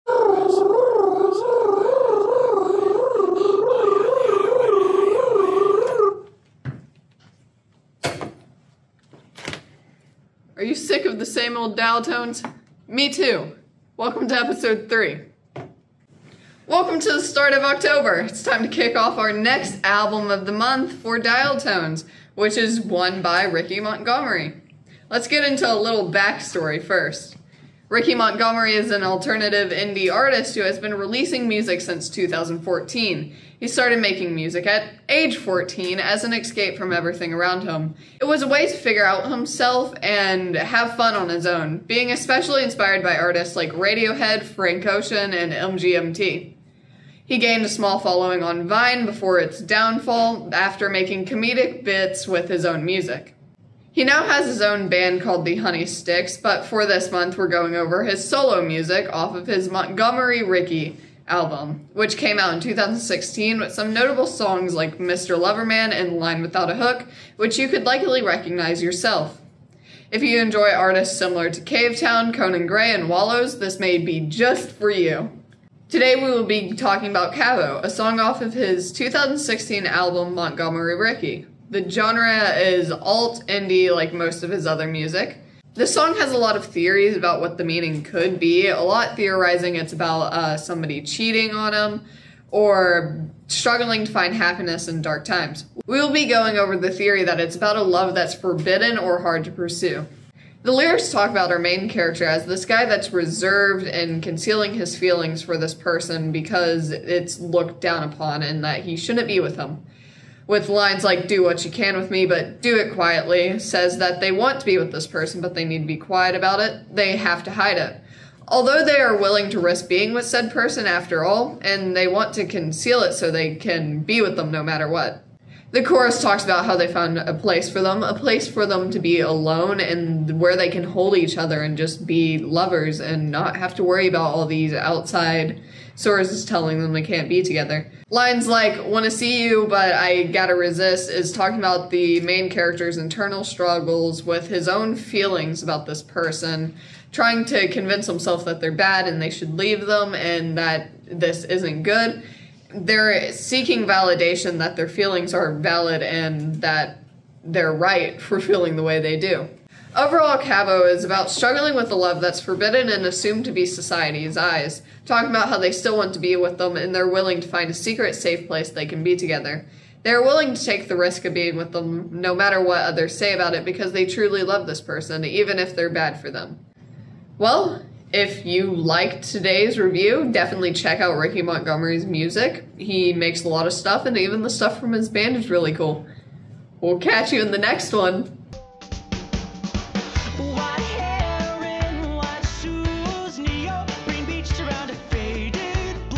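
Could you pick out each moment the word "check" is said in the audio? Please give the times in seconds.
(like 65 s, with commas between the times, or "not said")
180 s.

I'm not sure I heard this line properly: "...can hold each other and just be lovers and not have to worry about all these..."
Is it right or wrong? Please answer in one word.
right.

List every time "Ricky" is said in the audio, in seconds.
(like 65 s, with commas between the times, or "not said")
23 s, 27 s, 60 s, 80 s, 181 s.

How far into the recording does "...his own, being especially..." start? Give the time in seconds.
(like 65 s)
41 s.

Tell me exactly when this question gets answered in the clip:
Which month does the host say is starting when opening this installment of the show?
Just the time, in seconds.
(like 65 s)
17 s.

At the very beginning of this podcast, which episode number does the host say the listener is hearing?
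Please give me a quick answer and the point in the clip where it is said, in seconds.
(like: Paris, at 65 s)
3, at 14 s.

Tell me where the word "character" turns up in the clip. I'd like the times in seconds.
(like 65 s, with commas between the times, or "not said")
101 s, 142 s.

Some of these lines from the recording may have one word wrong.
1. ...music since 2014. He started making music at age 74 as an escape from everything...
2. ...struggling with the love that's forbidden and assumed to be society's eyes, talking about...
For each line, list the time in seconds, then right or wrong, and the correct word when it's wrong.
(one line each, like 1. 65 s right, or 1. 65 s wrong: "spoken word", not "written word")
1. 31 s wrong: "14", not "74"
2. 161 s right.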